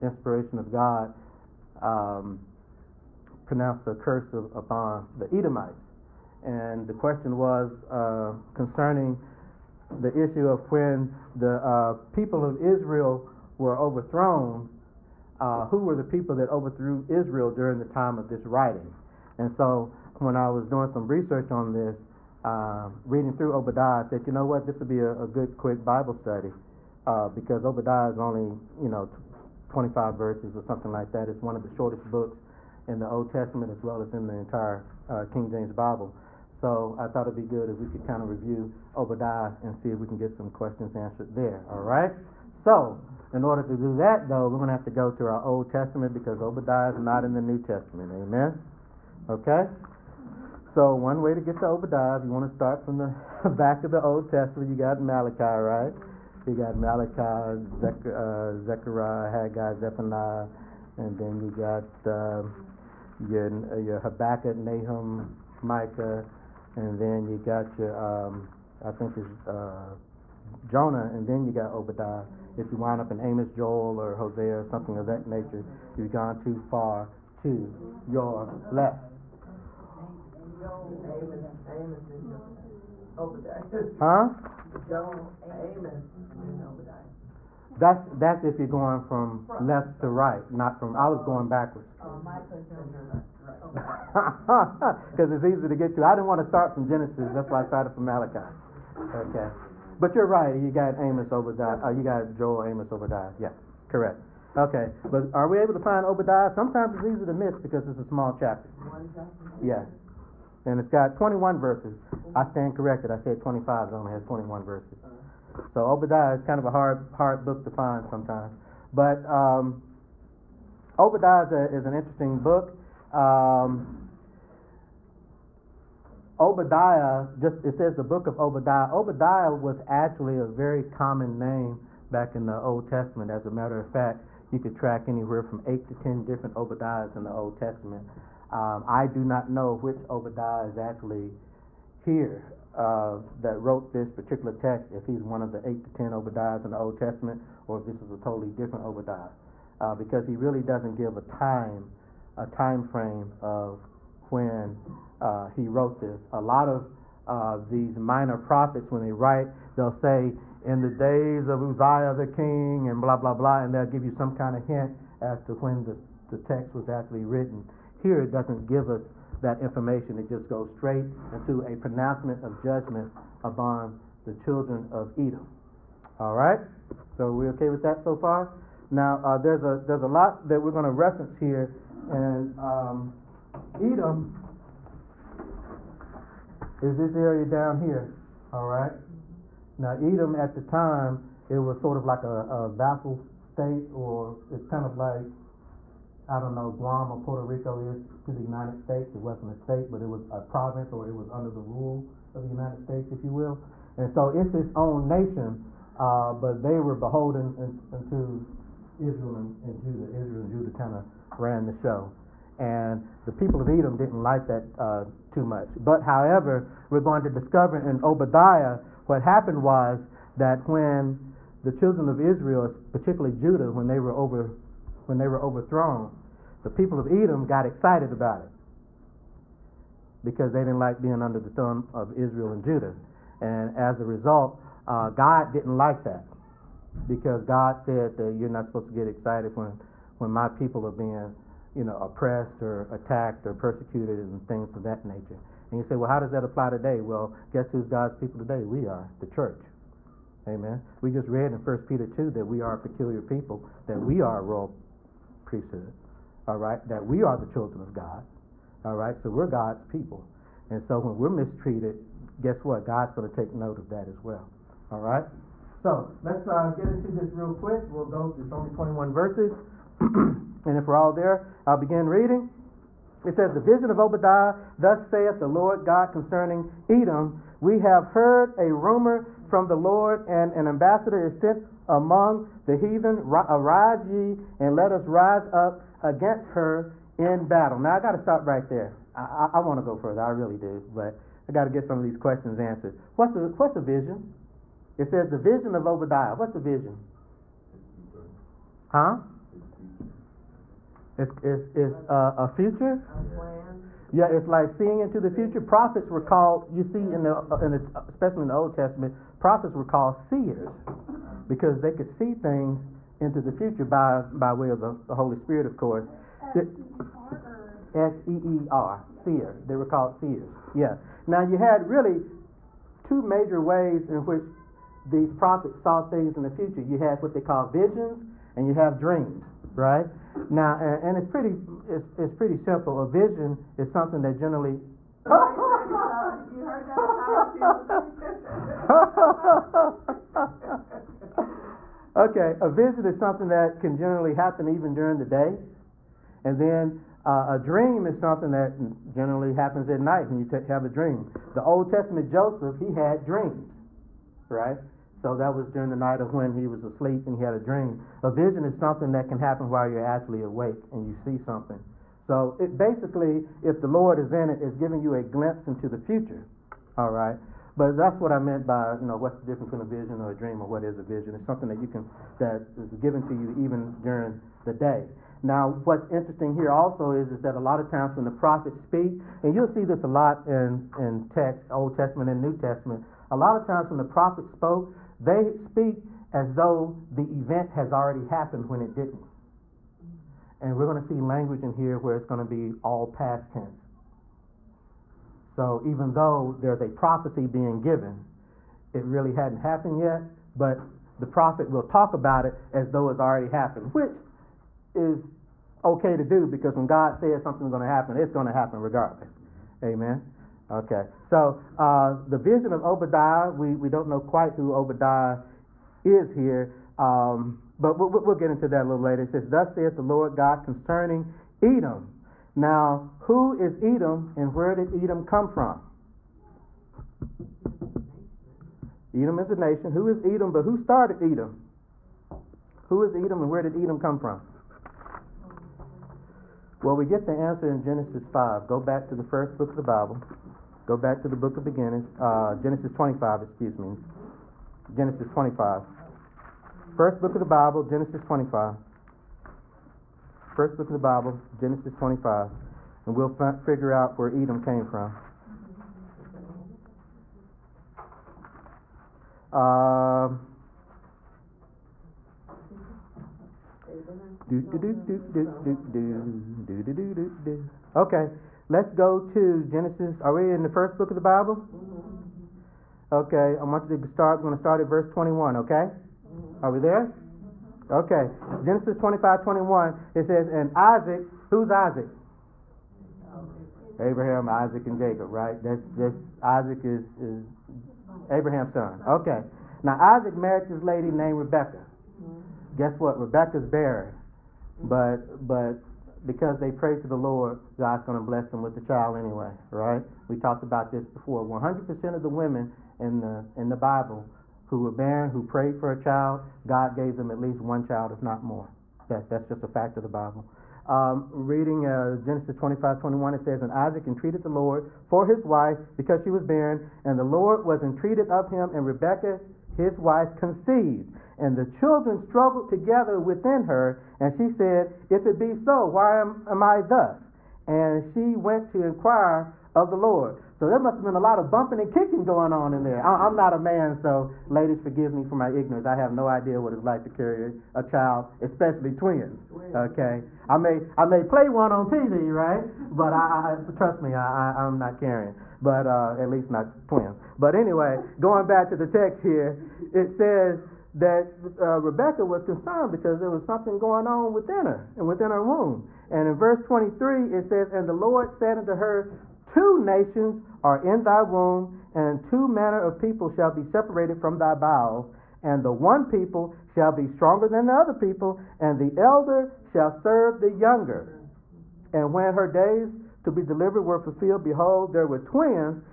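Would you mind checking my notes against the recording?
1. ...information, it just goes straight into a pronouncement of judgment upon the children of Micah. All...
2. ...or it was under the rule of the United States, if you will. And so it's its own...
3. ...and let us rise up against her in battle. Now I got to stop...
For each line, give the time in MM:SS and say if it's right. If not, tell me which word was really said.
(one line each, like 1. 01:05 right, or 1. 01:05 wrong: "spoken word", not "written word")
1. 02:49 wrong: "Edom", not "Micah"
2. 03:20 right
3. 04:44 right.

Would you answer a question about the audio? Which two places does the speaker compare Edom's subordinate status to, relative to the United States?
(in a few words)
Guam or Puerto Rico.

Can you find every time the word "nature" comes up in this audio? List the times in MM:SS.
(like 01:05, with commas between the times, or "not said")
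01:15, 04:05.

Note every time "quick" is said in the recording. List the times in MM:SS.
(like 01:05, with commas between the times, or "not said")
00:25, 04:27.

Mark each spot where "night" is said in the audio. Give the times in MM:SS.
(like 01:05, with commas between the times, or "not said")
05:50, 05:55.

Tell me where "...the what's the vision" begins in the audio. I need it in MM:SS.
04:53.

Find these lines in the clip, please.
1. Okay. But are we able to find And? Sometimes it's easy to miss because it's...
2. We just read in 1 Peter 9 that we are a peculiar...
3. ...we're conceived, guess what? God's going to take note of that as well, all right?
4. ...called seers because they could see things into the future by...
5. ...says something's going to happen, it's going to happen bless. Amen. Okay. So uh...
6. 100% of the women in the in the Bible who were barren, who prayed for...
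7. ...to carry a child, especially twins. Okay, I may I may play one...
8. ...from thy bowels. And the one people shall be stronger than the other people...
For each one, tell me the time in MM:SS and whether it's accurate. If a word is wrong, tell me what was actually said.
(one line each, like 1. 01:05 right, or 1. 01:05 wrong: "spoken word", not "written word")
1. 01:44 wrong: "Obadiah", not "And"
2. 04:10 wrong: "2", not "9"
3. 04:21 wrong: "mistreated", not "conceived"
4. 05:09 right
5. 06:47 wrong: "regardless", not "bless"
6. 08:21 right
7. 08:57 right
8. 09:24 right.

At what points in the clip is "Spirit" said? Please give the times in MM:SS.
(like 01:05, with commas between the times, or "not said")
05:15.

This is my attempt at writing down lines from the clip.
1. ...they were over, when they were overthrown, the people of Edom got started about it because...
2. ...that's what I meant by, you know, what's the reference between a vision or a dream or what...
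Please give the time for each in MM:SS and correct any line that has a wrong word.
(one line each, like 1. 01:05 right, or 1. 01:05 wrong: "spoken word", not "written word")
1. 03:43 wrong: "excited", not "started"
2. 06:07 wrong: "difference", not "reference".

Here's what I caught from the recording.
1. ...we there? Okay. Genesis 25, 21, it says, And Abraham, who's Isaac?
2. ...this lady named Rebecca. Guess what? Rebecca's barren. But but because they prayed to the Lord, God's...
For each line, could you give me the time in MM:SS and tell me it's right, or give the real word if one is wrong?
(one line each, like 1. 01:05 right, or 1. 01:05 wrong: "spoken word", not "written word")
1. 07:56 wrong: "Isaac", not "Abraham"
2. 08:10 right.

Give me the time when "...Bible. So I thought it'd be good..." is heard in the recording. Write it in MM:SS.
00:35.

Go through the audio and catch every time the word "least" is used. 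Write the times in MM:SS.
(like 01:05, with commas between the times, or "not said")
08:27, 09:06.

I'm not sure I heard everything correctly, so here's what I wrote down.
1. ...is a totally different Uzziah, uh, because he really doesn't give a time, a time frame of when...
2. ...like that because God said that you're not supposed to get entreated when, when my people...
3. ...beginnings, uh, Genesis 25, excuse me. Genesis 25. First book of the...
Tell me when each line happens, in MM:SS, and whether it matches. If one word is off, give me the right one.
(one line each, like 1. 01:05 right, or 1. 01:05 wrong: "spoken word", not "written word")
1. 02:28 wrong: "Obadiah", not "Uzziah"
2. 03:55 wrong: "excited", not "entreated"
3. 07:21 right.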